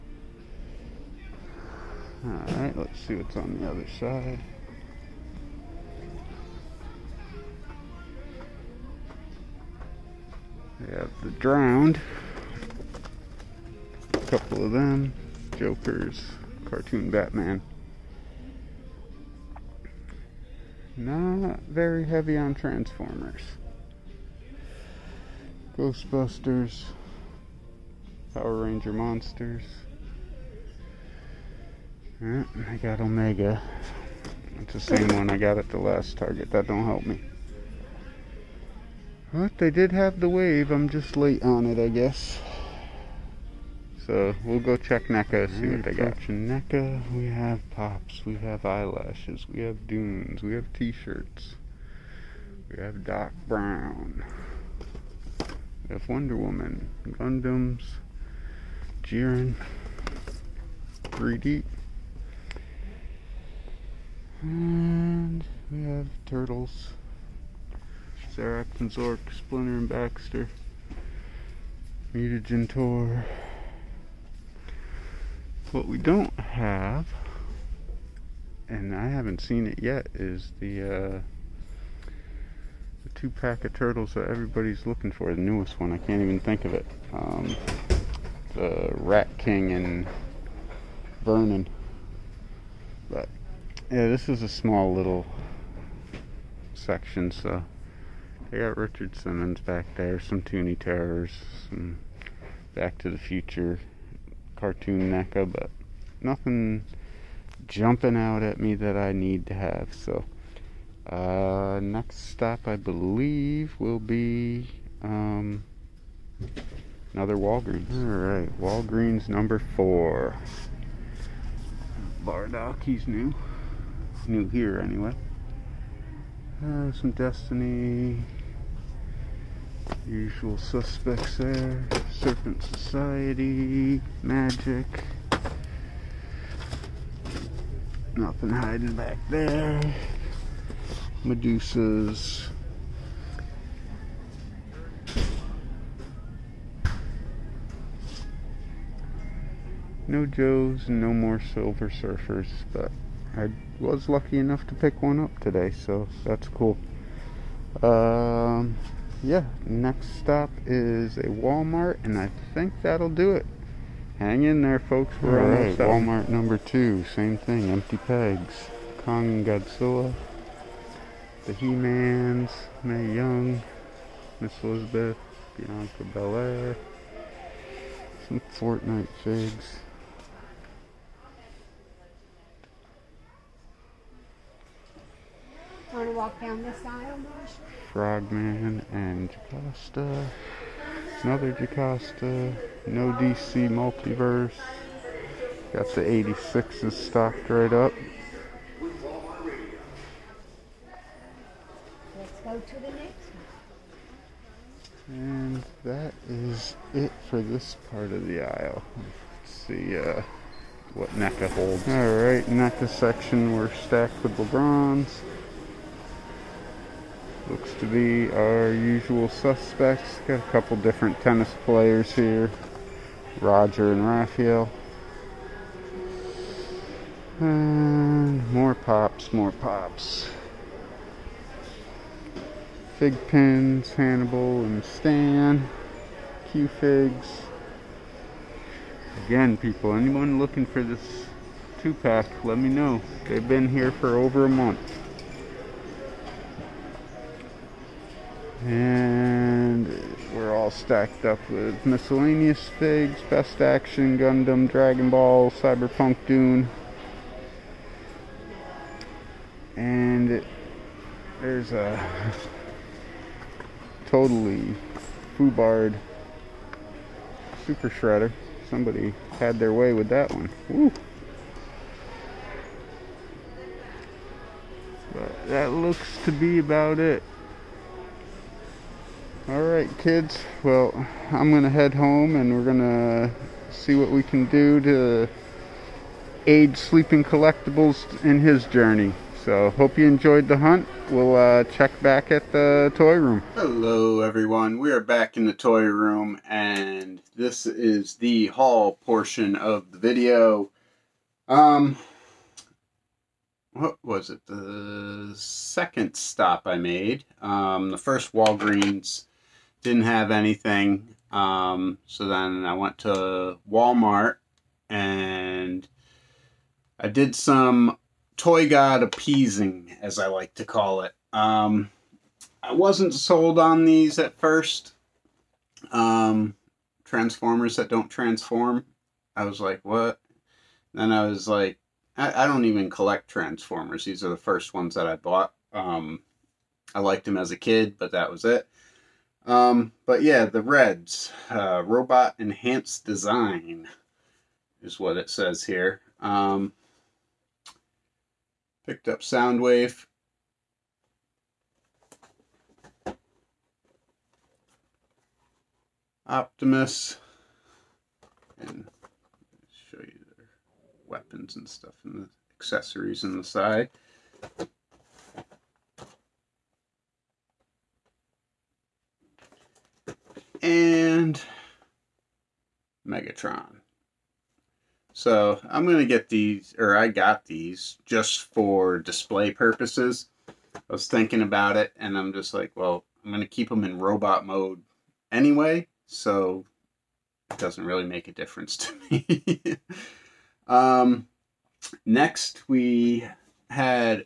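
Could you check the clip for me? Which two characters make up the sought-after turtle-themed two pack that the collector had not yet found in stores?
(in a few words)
Rat King and Vernon.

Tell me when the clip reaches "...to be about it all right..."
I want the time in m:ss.
4:36.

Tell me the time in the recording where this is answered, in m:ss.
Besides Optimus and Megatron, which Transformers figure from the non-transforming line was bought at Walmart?
5:49.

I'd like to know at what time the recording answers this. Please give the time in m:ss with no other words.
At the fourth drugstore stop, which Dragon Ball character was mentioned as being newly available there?
2:02.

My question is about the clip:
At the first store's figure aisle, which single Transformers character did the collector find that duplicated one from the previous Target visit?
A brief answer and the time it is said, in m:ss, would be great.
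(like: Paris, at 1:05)
Omega, at 0:33.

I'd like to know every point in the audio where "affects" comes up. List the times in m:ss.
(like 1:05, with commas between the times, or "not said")
not said.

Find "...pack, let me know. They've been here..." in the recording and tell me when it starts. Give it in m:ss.
4:01.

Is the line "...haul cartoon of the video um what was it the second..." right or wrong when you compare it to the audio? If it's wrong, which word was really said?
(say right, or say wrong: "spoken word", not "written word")
wrong: "portion", not "cartoon".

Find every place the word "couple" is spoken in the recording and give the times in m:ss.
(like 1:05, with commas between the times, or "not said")
0:14, 3:40.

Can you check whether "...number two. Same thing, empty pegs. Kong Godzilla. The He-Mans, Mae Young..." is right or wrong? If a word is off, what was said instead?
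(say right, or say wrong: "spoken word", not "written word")
right.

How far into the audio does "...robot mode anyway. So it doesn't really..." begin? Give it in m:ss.
6:23.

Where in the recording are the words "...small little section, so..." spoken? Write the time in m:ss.
1:34.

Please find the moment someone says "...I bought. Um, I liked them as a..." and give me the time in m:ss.
5:35.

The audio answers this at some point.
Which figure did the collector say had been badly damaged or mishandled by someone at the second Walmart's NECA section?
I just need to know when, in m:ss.
4:27.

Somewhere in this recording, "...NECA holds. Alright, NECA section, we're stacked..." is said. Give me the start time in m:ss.
3:31.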